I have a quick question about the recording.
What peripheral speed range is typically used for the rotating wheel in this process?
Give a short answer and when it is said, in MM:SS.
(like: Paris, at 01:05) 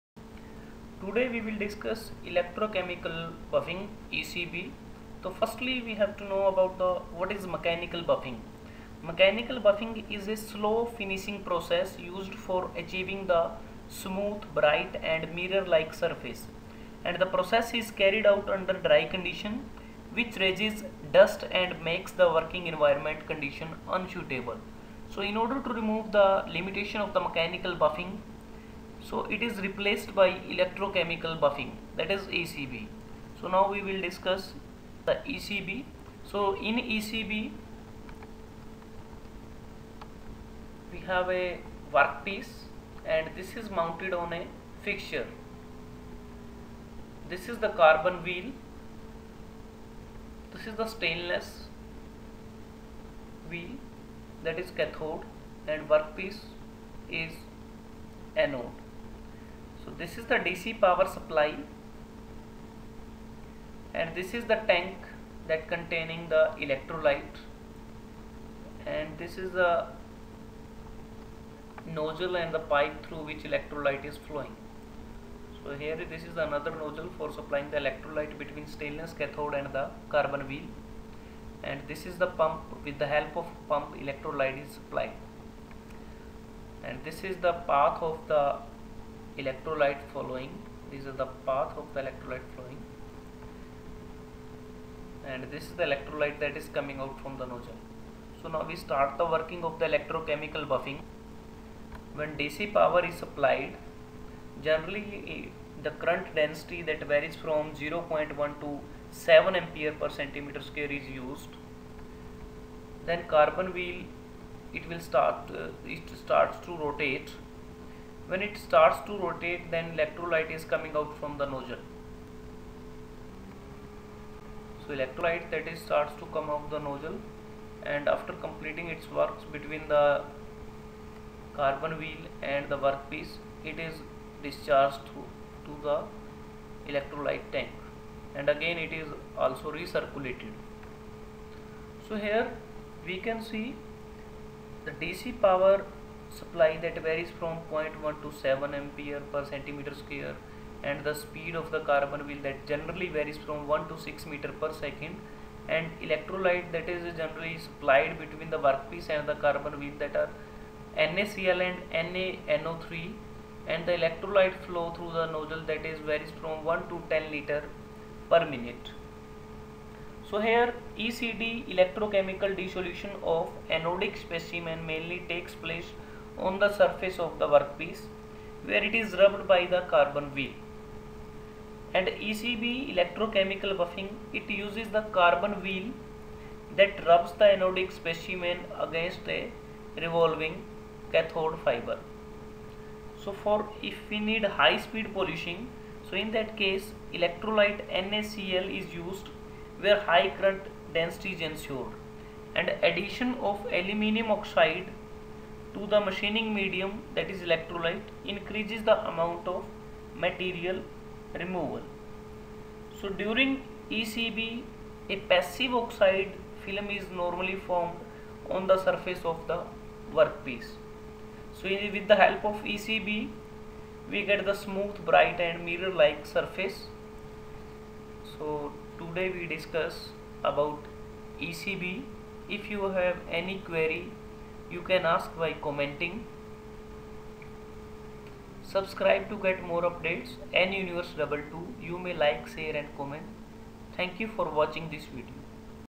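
1 to 6 m/s, at 02:33.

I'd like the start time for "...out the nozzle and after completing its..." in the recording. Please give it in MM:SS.
02:06.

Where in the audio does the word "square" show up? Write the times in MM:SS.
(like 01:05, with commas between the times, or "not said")
01:50, 02:30.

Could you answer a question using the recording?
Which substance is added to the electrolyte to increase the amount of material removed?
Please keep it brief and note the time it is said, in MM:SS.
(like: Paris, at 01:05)
aluminium oxide, at 03:23.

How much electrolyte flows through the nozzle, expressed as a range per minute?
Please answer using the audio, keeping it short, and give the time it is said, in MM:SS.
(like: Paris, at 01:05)
1 to 10 liters per minute, at 02:46.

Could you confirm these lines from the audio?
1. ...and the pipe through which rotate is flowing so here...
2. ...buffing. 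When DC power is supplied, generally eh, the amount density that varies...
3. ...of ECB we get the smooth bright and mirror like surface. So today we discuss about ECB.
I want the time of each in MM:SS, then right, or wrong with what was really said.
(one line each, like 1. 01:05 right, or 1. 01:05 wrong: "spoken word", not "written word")
1. 01:12 wrong: "electrolyte", not "rotate"
2. 01:40 wrong: "current", not "amount"
3. 03:42 right.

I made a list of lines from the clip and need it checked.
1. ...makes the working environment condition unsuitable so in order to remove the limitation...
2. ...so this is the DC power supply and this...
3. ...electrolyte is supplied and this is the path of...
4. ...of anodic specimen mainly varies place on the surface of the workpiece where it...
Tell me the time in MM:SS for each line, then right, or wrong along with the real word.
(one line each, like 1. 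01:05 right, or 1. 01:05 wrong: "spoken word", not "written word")
1. 00:21 right
2. 00:59 right
3. 01:23 right
4. 02:53 wrong: "takes", not "varies".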